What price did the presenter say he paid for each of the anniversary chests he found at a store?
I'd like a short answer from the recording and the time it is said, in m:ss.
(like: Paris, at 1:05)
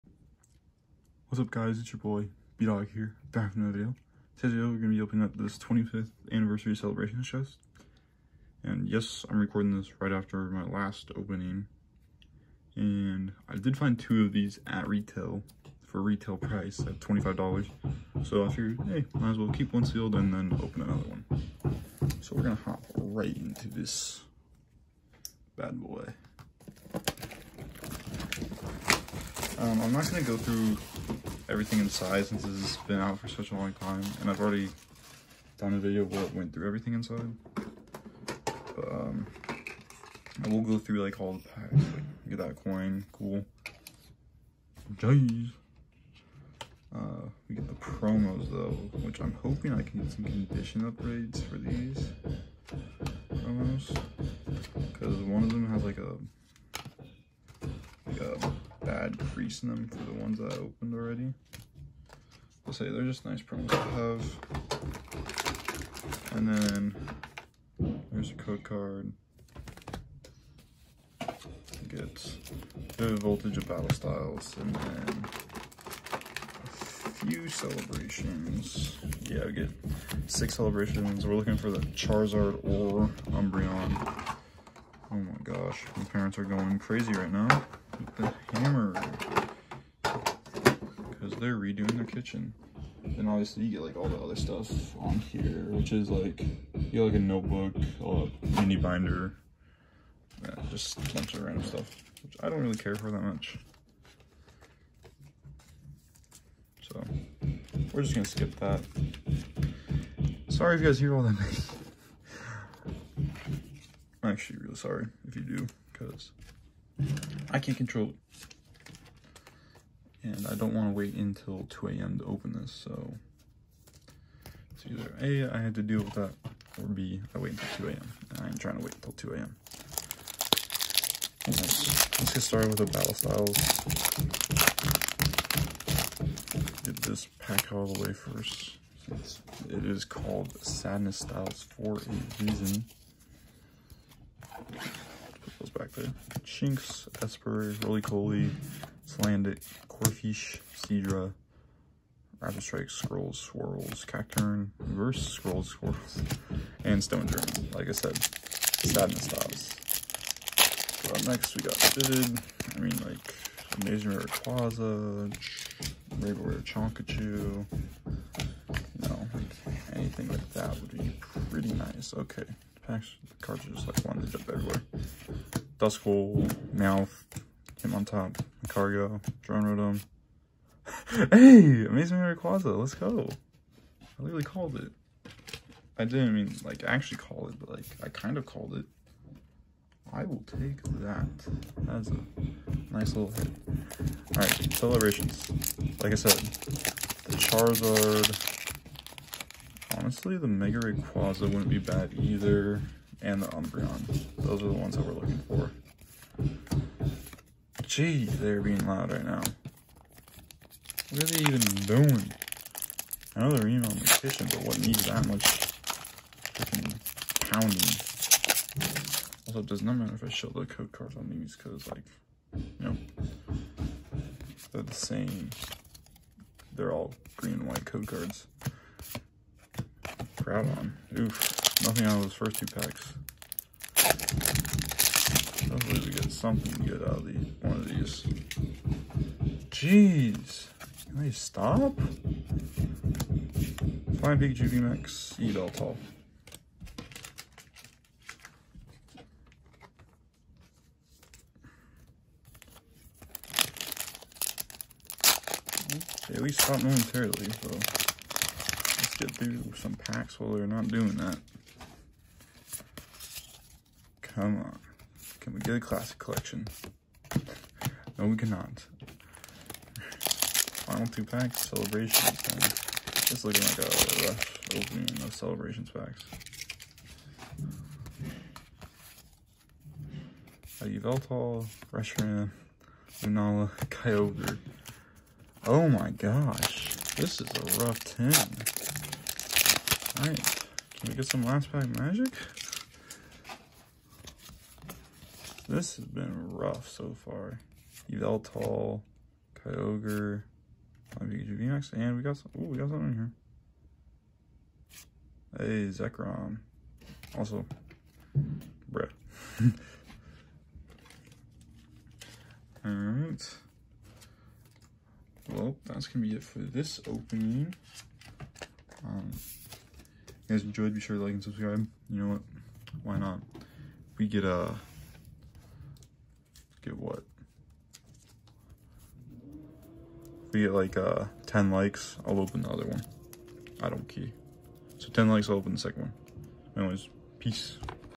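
$25, at 0:16.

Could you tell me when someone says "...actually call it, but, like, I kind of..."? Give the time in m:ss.
3:06.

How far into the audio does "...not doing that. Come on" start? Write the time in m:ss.
4:20.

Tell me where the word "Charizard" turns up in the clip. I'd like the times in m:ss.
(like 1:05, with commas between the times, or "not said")
1:21, 3:17.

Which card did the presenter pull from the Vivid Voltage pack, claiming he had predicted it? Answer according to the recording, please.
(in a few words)
Amazing Rayquaza.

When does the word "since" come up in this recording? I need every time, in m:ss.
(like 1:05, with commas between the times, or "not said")
0:32, 2:19.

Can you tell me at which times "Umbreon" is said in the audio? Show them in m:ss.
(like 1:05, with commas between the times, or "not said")
1:23, 3:23.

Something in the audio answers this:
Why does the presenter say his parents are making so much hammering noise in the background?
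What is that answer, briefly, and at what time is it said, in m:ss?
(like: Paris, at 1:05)
Redoing their kitchen, at 1:31.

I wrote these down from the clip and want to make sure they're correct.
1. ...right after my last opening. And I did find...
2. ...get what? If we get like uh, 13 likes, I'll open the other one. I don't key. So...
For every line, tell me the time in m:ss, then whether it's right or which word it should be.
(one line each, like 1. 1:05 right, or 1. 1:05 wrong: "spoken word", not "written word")
1. 0:10 right
2. 5:26 wrong: "10", not "13".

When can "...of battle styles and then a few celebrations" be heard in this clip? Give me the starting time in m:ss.
1:13.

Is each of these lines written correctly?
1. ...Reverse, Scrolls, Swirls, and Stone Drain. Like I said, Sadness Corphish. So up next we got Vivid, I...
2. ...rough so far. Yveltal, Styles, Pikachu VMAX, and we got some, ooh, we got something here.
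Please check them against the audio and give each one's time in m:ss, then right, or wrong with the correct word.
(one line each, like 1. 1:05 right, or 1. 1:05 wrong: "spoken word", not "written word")
1. 2:34 wrong: "Stops", not "Corphish"
2. 4:56 wrong: "Kyogre", not "Styles".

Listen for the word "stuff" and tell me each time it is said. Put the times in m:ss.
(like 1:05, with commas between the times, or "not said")
1:34, 1:41.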